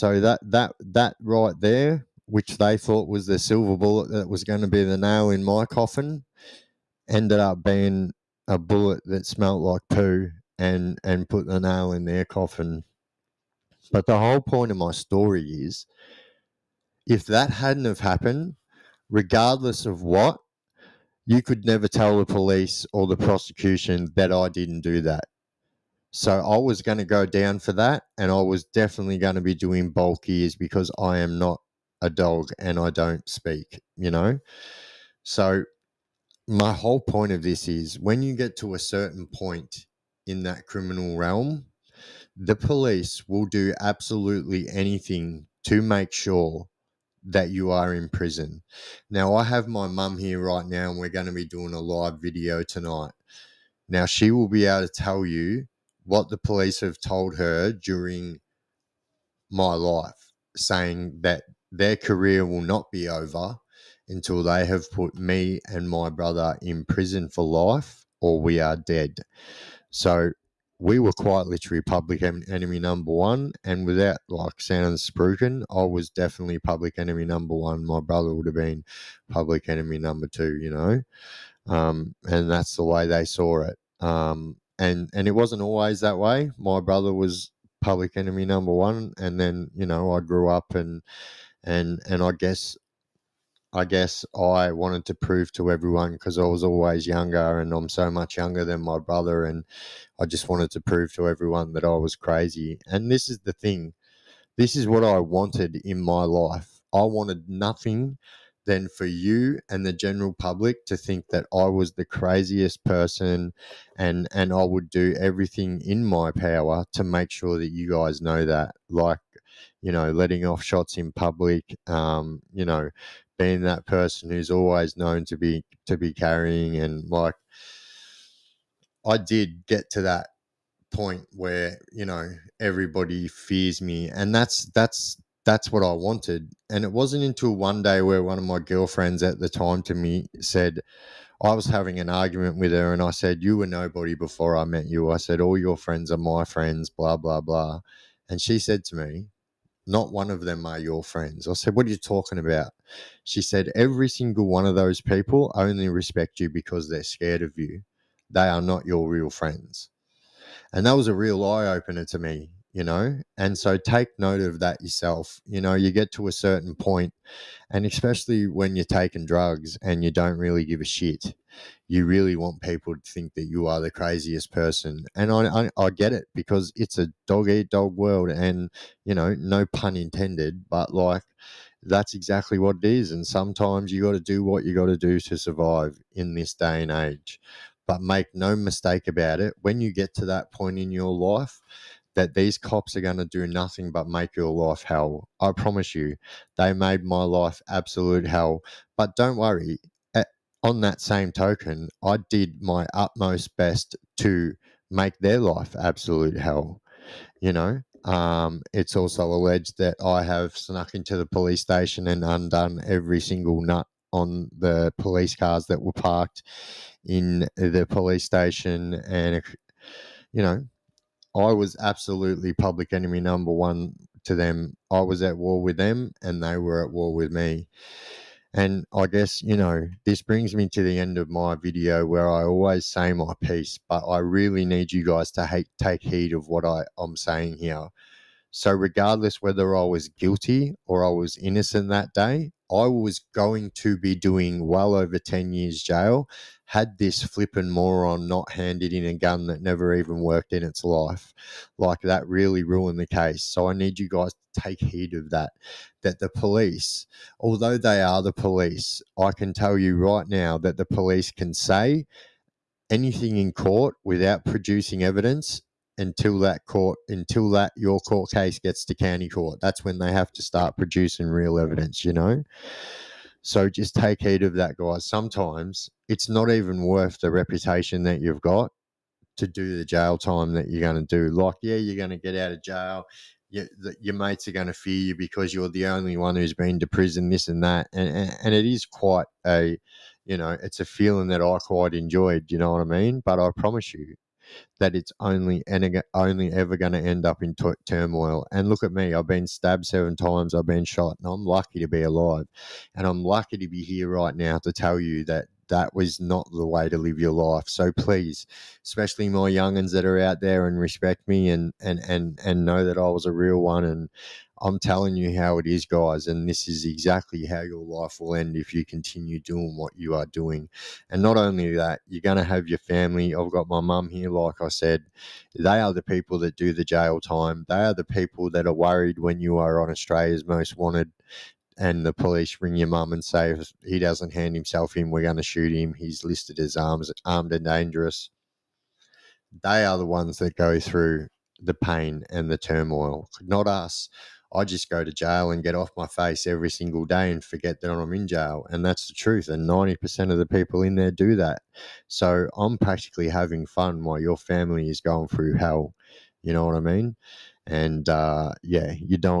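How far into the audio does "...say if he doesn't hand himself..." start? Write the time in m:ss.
5:33.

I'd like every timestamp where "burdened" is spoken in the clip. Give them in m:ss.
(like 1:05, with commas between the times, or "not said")
not said.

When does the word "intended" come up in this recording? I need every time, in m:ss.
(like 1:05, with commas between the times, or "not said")
2:59.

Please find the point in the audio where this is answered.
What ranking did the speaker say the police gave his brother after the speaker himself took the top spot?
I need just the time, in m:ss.
1:19.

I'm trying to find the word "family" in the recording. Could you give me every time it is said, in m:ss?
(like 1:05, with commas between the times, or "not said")
5:22, 5:54.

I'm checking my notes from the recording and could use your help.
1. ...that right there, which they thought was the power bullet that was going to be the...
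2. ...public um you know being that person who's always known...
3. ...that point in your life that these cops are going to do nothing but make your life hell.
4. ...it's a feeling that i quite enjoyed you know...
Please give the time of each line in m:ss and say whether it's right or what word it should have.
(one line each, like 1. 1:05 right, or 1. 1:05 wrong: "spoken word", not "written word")
1. 0:00 wrong: "silver", not "power"
2. 2:01 right
3. 3:10 right
4. 4:50 right.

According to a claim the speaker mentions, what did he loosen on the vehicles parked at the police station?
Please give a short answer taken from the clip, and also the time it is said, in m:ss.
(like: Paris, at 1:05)
Every single nut, at 3:32.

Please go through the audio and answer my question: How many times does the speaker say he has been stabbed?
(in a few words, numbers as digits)
7.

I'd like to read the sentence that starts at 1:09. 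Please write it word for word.
So, we were quite literally public enemy number one.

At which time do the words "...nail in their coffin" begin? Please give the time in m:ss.
0:11.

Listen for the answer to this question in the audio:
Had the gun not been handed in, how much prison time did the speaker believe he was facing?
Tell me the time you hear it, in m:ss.
4:04.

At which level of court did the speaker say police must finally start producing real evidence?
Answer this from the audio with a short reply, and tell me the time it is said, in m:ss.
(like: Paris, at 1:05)
County court, at 4:28.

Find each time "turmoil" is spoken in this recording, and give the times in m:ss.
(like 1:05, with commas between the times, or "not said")
4:57, 5:42.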